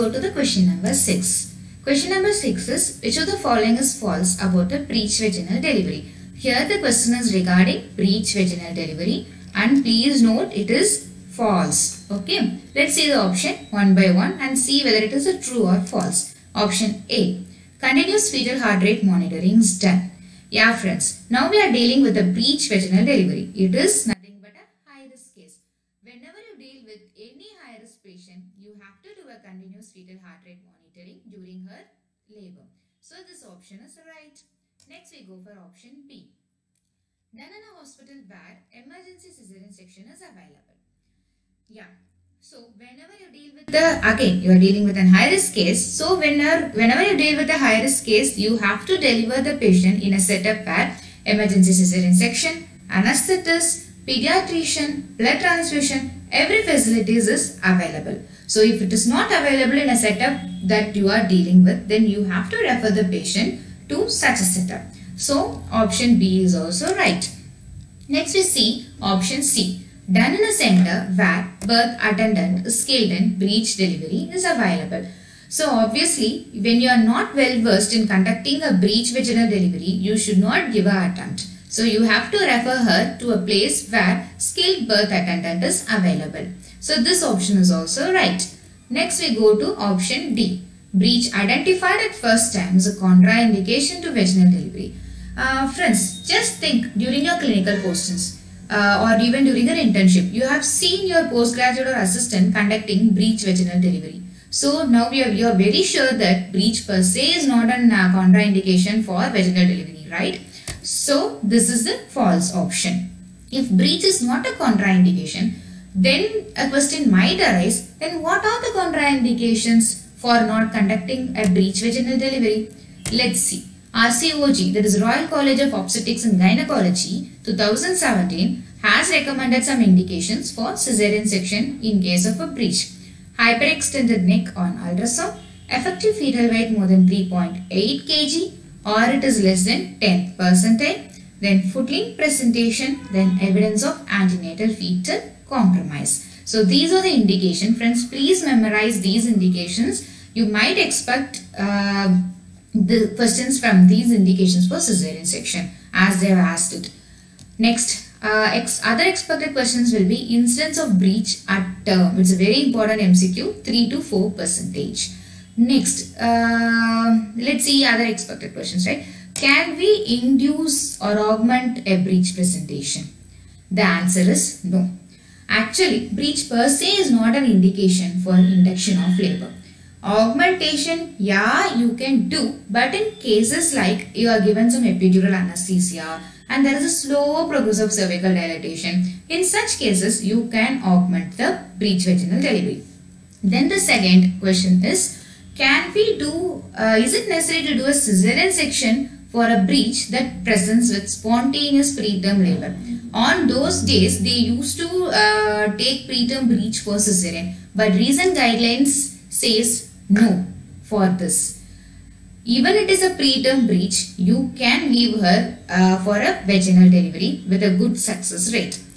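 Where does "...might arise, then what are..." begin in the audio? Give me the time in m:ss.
1:57.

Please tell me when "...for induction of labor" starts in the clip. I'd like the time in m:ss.
2:58.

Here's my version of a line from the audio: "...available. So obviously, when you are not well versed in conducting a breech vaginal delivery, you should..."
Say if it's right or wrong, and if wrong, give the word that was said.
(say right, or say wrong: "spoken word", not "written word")
right.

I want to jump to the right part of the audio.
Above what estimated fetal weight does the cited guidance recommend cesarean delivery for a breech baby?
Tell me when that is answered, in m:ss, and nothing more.
2:17.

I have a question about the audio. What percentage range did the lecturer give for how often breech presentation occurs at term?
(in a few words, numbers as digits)
3 to 4 percent.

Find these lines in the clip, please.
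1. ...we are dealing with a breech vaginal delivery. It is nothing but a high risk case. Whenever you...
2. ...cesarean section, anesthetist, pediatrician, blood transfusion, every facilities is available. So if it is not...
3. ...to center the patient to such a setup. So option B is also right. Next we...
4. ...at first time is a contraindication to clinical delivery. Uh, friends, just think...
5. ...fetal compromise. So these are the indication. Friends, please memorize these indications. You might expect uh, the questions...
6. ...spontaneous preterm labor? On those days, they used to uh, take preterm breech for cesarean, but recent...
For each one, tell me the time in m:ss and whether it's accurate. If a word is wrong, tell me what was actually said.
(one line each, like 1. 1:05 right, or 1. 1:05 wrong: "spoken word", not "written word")
1. 0:21 right
2. 0:51 right
3. 1:02 wrong: "refer", not "center"
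4. 1:32 wrong: "vaginal", not "clinical"
5. 2:24 right
6. 3:21 right.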